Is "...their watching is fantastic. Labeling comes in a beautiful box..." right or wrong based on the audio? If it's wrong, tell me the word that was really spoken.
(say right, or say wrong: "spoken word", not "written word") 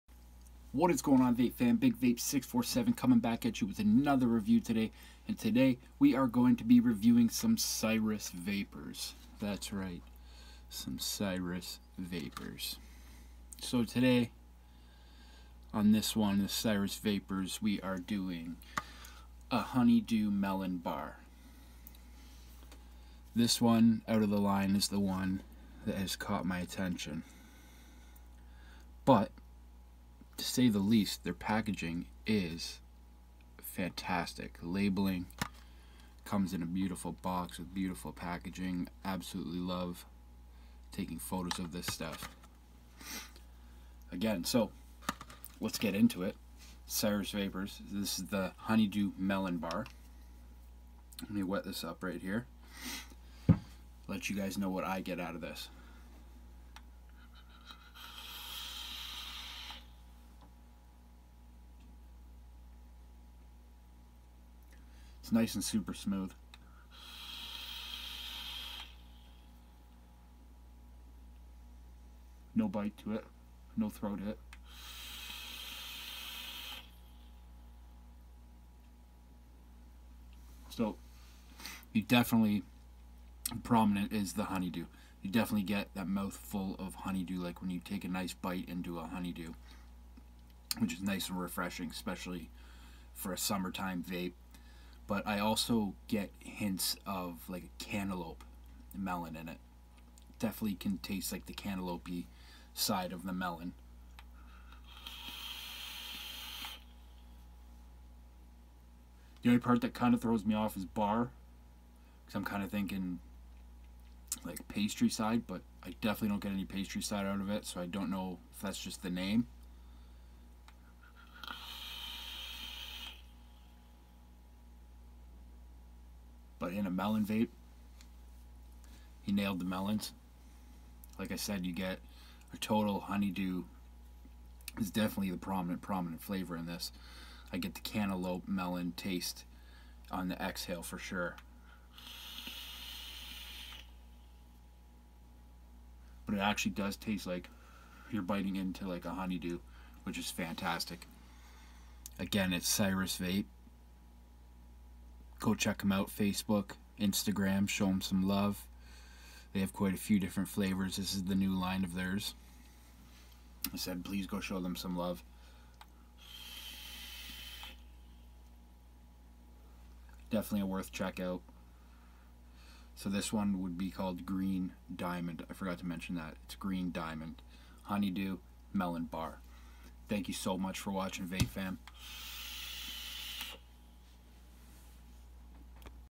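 wrong: "packaging", not "watching".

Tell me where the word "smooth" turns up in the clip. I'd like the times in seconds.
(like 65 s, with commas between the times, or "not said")
65 s.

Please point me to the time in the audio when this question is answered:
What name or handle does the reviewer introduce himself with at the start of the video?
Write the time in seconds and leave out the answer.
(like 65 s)
1 s.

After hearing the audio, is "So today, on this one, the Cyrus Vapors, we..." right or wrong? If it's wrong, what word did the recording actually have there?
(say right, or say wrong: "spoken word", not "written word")
right.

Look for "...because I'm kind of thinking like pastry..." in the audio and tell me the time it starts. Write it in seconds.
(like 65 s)
112 s.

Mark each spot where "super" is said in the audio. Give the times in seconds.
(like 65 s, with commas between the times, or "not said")
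65 s.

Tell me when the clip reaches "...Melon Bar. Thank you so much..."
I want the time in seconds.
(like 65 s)
178 s.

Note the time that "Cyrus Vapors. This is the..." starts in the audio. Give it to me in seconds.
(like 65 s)
46 s.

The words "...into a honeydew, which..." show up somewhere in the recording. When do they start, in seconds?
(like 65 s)
88 s.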